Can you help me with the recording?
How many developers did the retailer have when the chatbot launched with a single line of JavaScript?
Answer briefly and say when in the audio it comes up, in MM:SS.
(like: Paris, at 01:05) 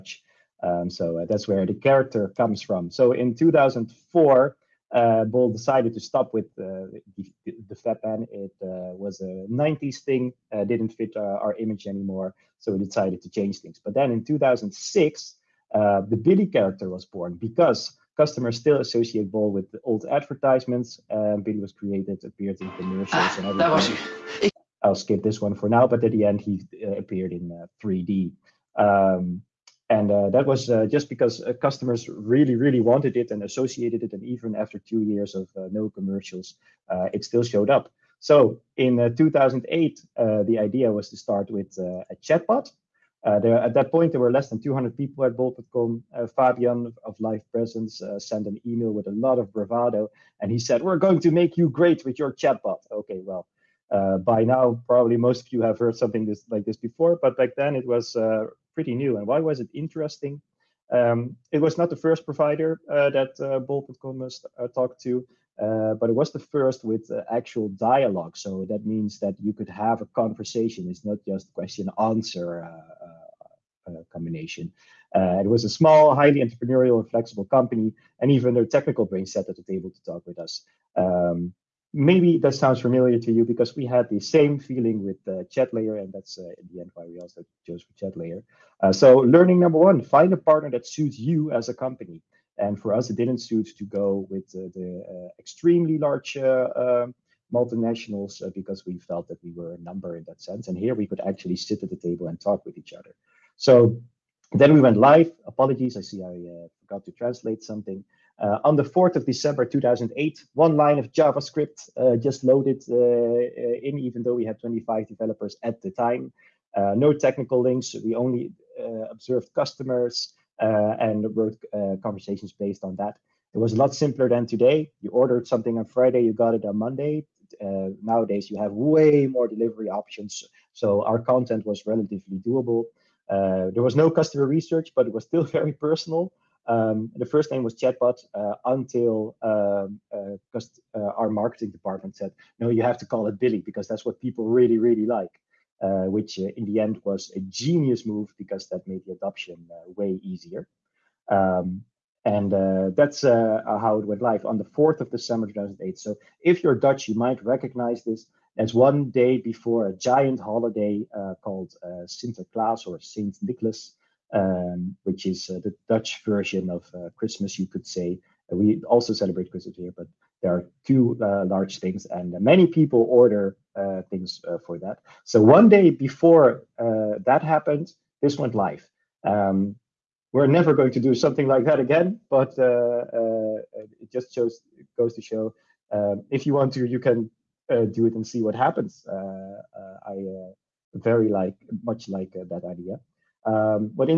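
25, at 01:54.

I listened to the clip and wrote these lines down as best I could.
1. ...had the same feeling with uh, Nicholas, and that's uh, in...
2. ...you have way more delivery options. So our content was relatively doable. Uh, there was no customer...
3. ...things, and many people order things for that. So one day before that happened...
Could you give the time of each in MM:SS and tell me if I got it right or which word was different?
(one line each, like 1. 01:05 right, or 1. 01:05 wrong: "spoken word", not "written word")
1. 01:23 wrong: "ChatLayer", not "Nicholas"
2. 02:08 right
3. 02:51 right.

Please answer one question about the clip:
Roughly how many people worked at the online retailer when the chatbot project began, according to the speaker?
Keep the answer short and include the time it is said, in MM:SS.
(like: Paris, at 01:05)
less than 200, at 00:44.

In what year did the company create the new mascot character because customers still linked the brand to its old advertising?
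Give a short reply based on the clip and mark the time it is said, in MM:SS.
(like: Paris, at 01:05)
2006, at 00:14.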